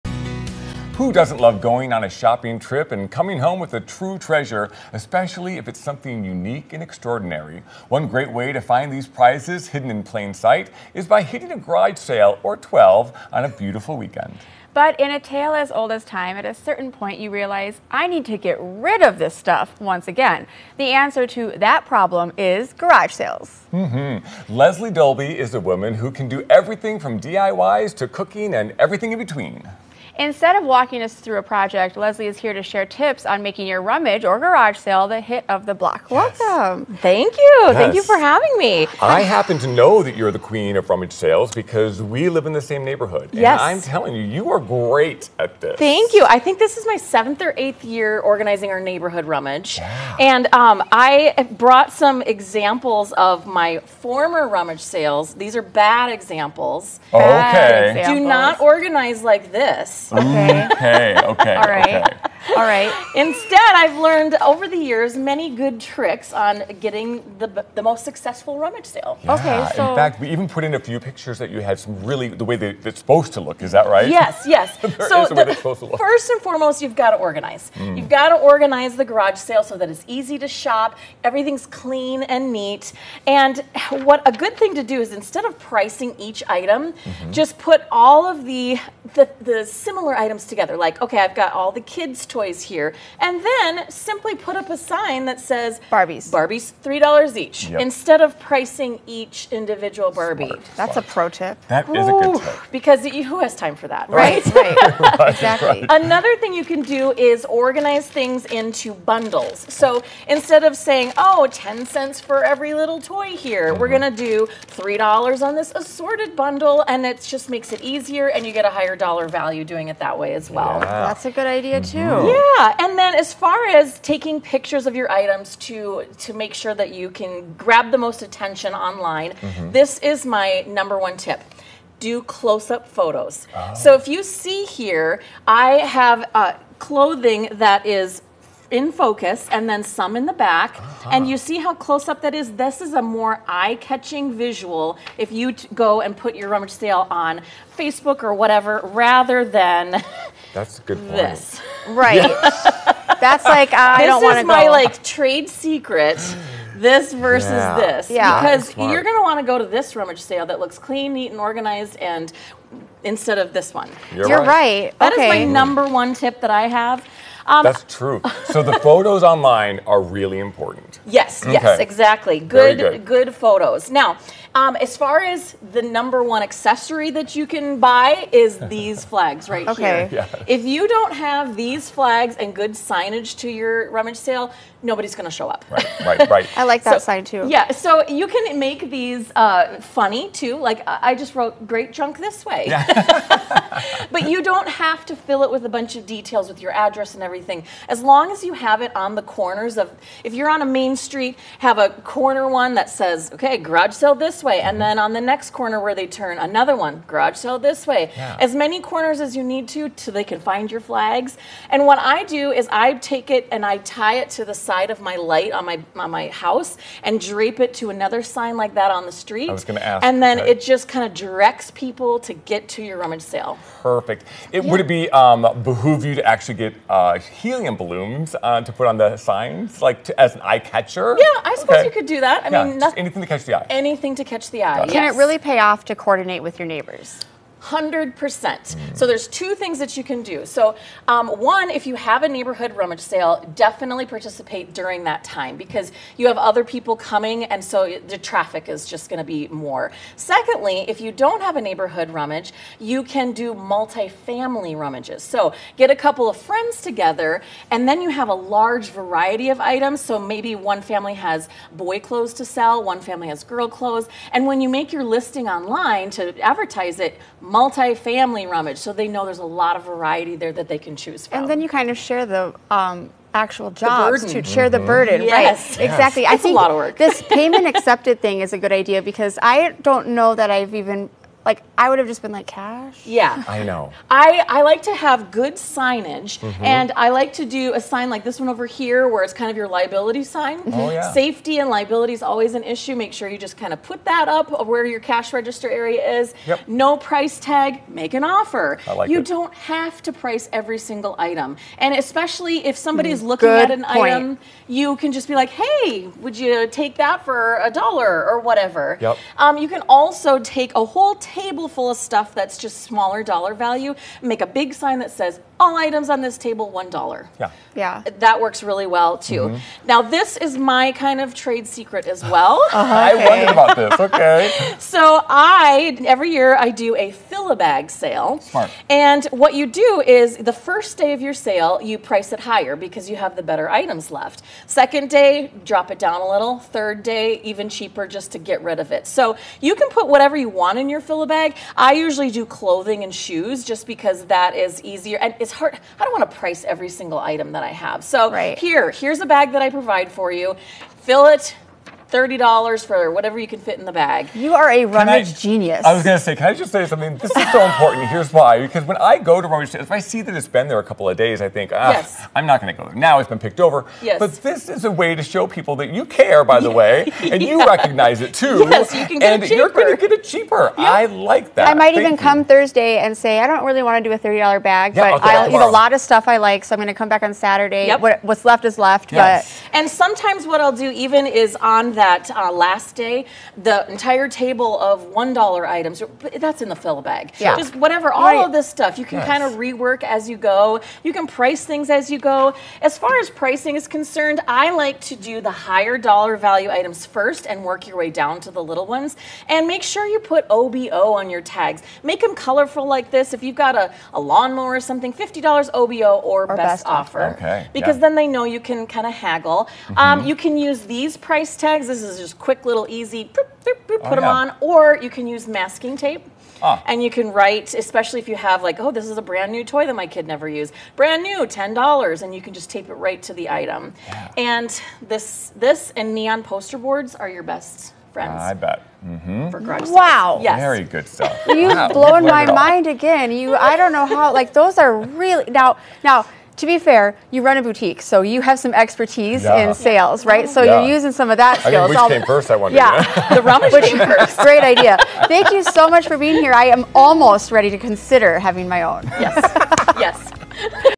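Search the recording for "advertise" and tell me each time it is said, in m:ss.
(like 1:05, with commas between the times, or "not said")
4:26.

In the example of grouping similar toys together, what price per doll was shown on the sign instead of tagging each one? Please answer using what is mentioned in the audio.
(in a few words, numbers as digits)
$3 each.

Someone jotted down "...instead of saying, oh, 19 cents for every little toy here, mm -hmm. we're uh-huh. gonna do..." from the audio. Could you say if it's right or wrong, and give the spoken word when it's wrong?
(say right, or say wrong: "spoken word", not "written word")
wrong: "10", not "19".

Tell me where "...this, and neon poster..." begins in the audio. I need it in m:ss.
7:05.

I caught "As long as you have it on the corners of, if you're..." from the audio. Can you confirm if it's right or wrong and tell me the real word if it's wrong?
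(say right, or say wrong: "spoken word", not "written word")
right.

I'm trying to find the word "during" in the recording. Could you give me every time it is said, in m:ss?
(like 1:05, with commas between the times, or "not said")
4:04.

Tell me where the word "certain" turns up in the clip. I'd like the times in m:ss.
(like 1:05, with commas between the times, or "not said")
0:16.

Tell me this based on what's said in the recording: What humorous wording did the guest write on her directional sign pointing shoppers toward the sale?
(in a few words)
Great Junk This Way.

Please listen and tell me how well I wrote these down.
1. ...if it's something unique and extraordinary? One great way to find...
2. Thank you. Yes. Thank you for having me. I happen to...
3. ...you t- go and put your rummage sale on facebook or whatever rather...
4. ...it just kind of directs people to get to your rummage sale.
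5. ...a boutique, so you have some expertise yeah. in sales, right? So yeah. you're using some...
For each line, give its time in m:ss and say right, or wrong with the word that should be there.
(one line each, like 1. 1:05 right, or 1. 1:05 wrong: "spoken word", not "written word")
1. 0:05 right
2. 0:36 right
3. 2:25 right
4. 3:40 right
5. 7:17 right.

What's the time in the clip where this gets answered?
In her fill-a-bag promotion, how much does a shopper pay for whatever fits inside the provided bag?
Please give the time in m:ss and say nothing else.
5:52.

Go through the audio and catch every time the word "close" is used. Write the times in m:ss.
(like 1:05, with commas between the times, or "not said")
2:12, 2:21.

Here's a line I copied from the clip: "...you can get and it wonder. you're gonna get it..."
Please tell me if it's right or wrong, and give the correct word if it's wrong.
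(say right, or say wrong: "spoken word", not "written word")
wrong: "cheaper", not "wonder".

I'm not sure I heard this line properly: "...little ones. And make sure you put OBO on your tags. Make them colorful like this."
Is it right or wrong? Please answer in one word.
right.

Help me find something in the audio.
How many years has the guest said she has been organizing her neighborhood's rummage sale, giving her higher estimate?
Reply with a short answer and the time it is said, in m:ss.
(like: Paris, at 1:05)
8, at 0:47.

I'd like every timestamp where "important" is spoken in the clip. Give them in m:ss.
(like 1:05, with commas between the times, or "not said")
2:50, 5:57.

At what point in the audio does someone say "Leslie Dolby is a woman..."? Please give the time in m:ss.
0:24.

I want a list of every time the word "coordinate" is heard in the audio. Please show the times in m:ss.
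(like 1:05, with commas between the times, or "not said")
3:55.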